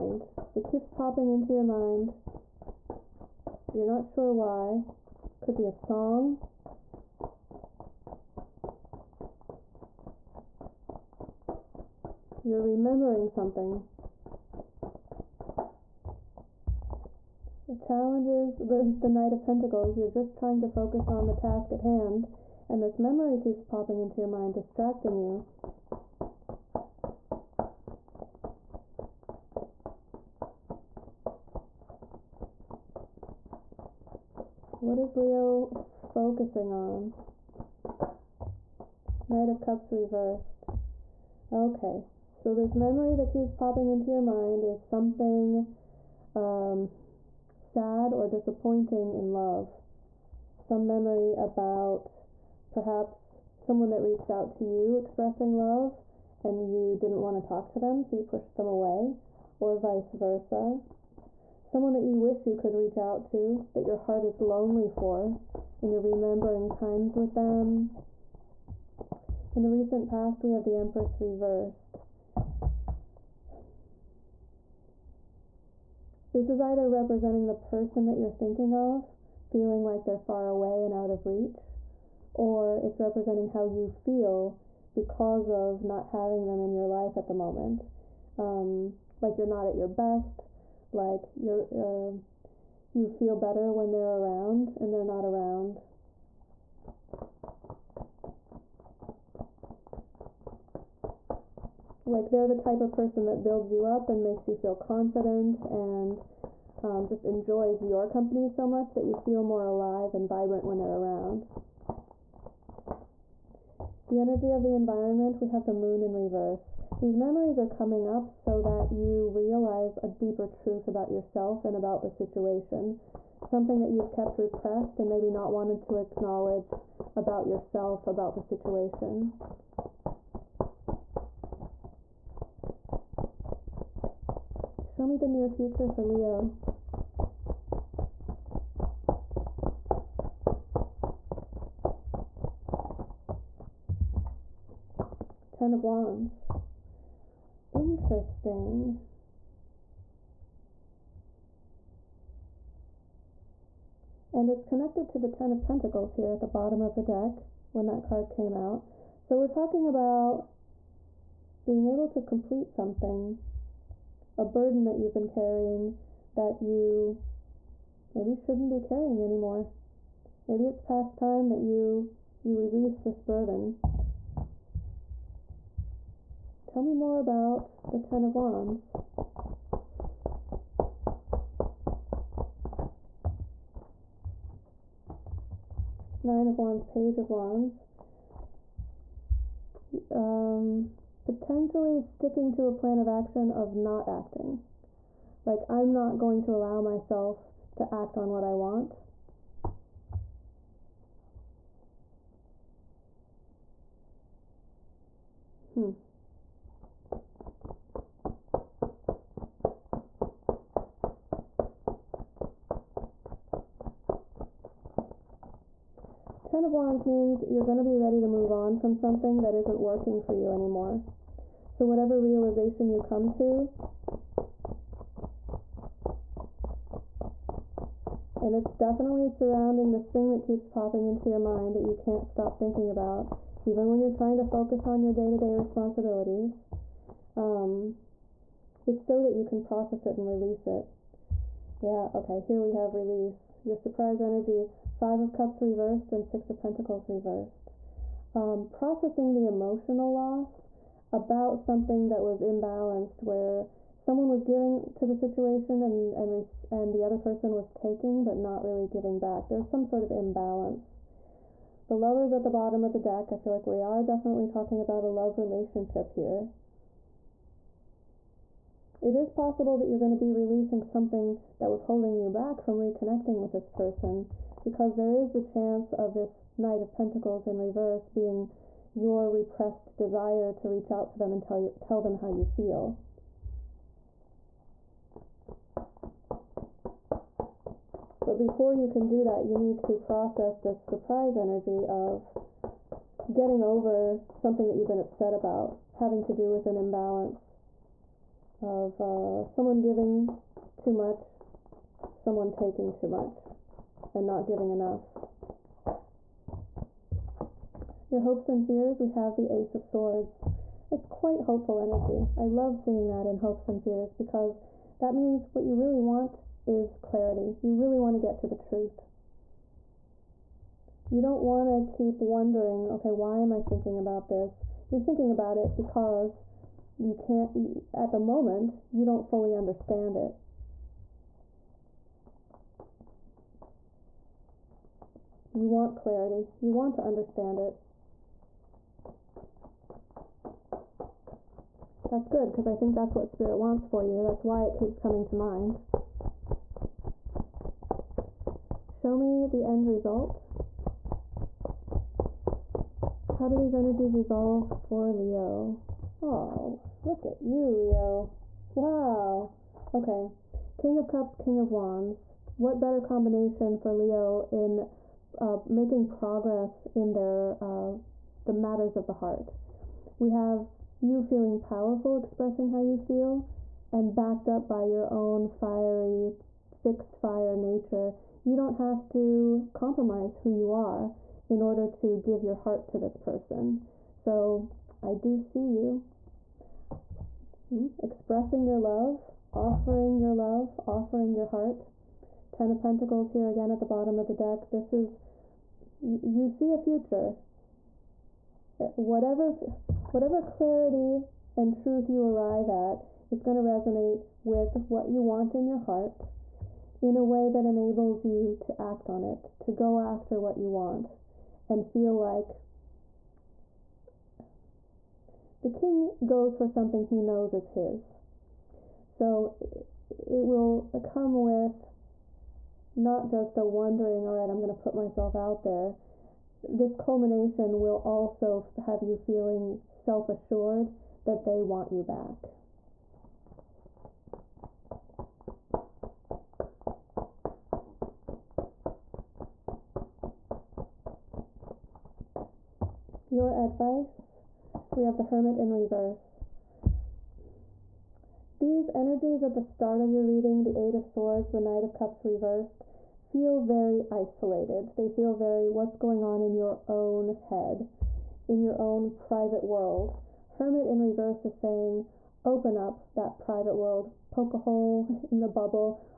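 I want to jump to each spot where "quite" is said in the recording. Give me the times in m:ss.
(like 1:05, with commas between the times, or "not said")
5:11.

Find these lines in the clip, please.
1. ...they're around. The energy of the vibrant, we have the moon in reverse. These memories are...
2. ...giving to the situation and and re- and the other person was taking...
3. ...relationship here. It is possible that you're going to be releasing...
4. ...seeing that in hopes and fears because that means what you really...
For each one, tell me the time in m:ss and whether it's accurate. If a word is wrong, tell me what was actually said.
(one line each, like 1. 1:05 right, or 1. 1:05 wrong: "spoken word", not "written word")
1. 1:50 wrong: "environment", not "vibrant"
2. 4:14 right
3. 4:25 right
4. 5:12 right.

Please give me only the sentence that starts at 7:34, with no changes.
They feel very what's going on in your own head, in your own private world.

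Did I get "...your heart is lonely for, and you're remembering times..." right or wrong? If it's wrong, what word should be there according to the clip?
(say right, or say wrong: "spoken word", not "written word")
right.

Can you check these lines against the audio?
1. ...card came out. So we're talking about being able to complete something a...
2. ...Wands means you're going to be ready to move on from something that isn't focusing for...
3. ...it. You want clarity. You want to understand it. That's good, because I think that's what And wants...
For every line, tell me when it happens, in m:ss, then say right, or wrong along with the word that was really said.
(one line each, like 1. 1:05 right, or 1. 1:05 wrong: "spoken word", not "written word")
1. 2:38 right
2. 3:36 wrong: "working", not "focusing"
3. 5:30 wrong: "Spirit", not "And".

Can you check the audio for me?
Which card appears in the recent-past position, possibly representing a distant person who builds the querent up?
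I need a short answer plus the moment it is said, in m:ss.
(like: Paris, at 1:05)
Empress reversed, at 1:10.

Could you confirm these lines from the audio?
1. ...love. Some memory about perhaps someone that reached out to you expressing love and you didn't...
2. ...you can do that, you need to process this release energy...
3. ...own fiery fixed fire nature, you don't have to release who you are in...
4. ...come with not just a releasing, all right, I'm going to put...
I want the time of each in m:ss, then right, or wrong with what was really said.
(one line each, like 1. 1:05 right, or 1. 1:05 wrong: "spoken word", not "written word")
1. 0:49 right
2. 4:48 wrong: "surprise", not "release"
3. 6:15 wrong: "compromise", not "release"
4. 7:01 wrong: "wondering", not "releasing".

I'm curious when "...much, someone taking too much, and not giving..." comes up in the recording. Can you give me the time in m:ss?
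5:00.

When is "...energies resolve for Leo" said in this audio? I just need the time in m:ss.
5:53.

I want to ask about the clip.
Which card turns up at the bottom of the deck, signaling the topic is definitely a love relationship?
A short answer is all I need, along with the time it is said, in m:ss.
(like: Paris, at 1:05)
The Lovers, at 4:21.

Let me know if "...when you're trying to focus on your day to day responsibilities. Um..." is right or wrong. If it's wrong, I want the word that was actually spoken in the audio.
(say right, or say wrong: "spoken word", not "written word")
right.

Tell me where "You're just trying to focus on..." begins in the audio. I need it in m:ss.
0:19.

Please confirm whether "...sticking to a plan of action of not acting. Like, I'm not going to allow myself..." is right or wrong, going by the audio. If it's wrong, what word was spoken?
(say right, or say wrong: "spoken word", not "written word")
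right.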